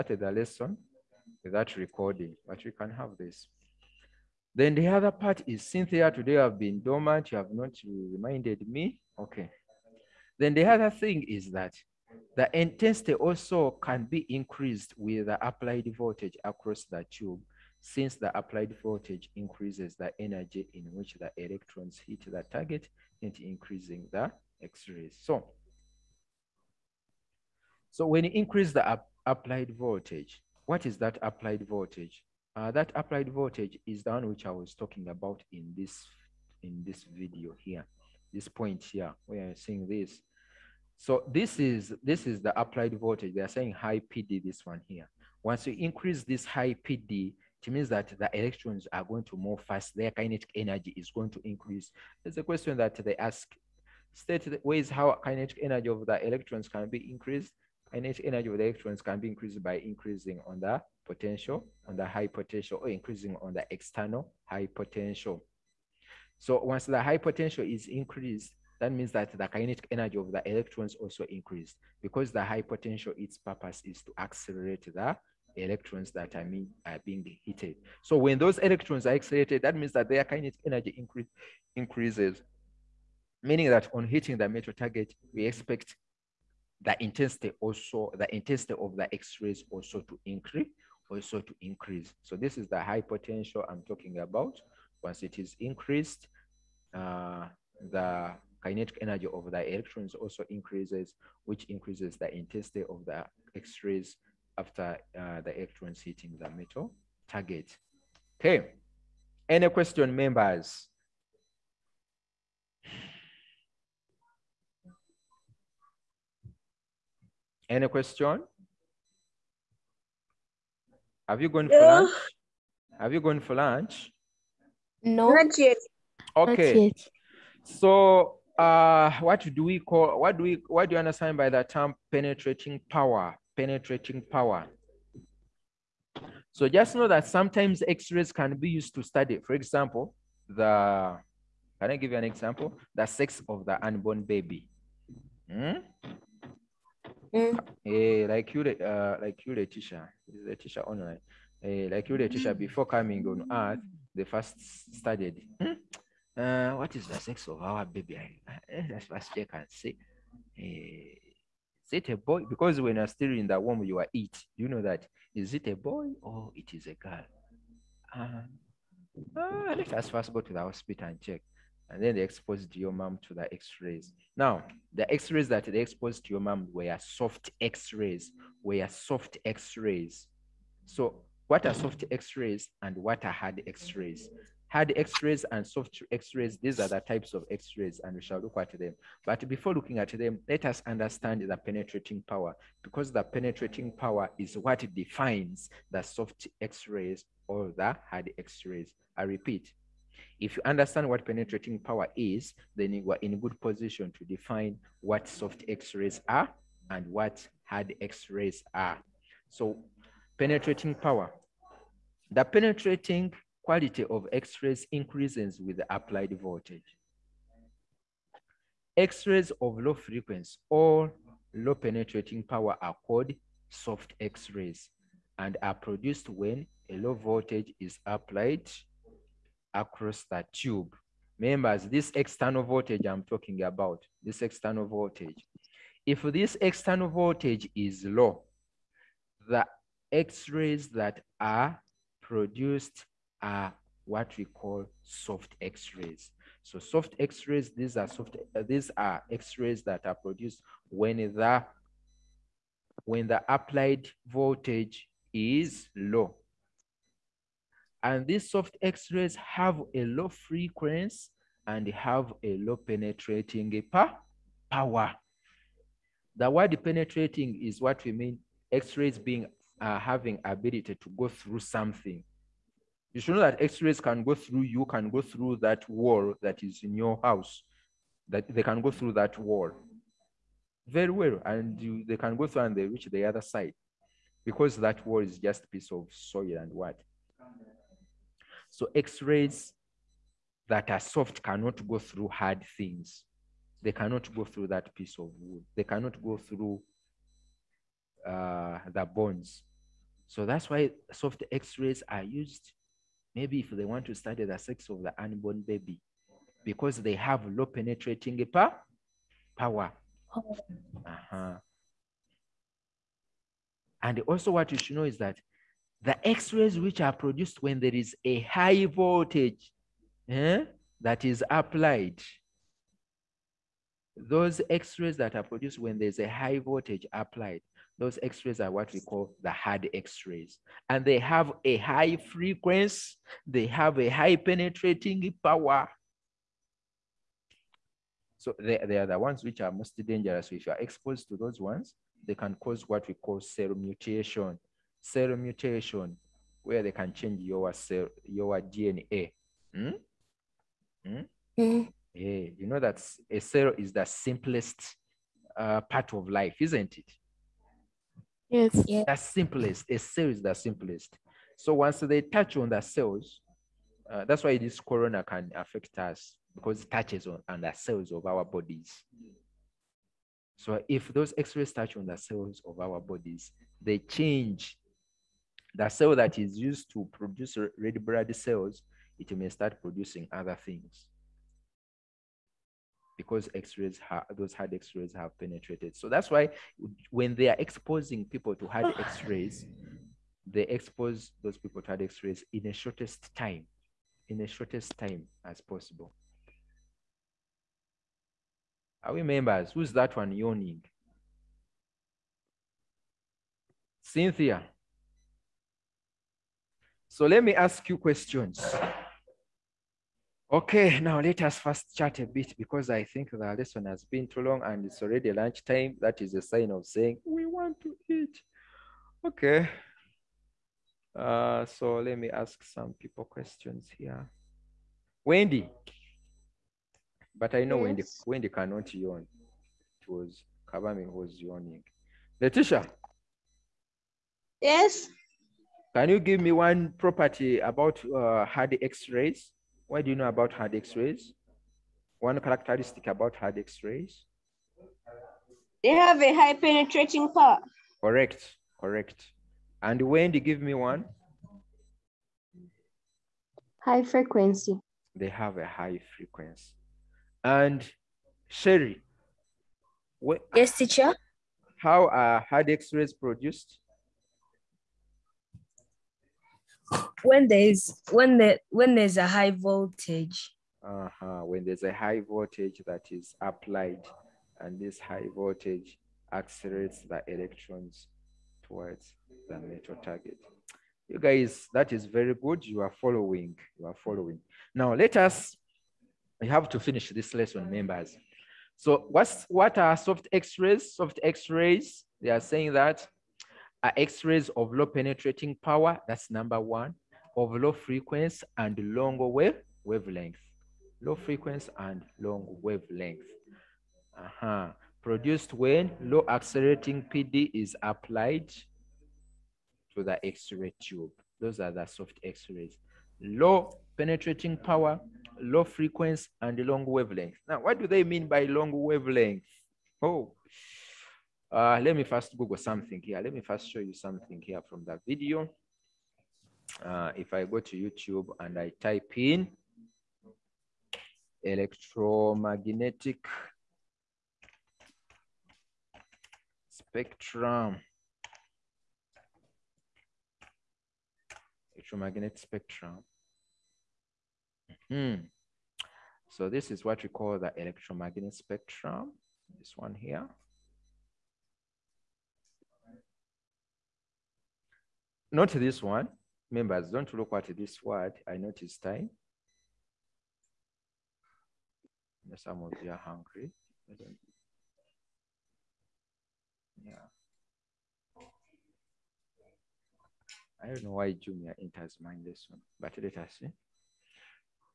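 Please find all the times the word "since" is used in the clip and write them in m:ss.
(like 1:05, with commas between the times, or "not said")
0:17.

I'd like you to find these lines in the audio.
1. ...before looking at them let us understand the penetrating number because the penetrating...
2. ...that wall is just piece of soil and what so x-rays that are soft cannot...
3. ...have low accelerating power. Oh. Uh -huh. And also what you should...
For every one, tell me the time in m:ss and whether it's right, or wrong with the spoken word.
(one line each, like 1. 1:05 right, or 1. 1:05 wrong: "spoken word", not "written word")
1. 3:09 wrong: "power", not "number"
2. 4:44 right
3. 5:07 wrong: "penetrating", not "accelerating".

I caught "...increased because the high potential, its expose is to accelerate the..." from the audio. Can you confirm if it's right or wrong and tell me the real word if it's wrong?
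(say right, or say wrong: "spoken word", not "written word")
wrong: "purpose", not "expose".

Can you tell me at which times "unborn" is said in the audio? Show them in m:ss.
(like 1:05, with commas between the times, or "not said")
2:23, 5:05.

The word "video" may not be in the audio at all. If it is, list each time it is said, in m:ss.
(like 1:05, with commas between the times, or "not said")
0:37, 8:45.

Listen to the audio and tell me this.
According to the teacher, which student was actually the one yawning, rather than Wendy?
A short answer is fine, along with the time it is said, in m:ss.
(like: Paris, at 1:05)
Kabami, at 7:10.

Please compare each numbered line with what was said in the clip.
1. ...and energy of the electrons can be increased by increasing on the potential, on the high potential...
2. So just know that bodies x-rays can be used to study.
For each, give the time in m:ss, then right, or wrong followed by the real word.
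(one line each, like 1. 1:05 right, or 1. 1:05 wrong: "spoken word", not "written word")
1. 0:57 right
2. 2:16 wrong: "sometimes", not "bodies".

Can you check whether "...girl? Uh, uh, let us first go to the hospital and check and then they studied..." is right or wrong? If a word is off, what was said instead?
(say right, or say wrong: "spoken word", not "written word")
wrong: "exposed", not "studied".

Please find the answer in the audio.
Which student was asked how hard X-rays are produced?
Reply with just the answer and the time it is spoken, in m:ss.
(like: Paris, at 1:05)
Sherry, at 7:38.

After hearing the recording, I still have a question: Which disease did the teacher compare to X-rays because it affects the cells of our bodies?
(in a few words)
Corona.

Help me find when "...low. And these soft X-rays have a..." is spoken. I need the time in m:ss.
4:15.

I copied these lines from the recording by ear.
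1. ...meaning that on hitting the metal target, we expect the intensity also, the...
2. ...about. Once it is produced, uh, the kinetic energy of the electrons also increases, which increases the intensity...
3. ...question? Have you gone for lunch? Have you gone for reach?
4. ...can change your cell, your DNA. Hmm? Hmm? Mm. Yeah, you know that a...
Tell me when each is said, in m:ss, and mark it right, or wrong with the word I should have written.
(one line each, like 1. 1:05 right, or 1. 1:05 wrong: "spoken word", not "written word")
1. 1:23 right
2. 1:34 wrong: "increased", not "produced"
3. 1:57 wrong: "lunch", not "reach"
4. 5:46 right.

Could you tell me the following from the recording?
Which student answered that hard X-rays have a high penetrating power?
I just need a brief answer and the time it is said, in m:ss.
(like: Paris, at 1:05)
Letitia, at 7:12.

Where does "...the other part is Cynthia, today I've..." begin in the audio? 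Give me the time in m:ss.
0:04.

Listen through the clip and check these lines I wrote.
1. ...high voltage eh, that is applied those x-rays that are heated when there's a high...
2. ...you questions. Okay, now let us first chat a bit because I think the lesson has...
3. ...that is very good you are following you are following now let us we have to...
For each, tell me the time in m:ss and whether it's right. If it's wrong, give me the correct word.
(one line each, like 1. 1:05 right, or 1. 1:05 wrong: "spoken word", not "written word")
1. 5:18 wrong: "produced", not "heated"
2. 6:47 right
3. 8:01 right.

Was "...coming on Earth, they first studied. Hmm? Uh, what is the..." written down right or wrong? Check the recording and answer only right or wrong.
right.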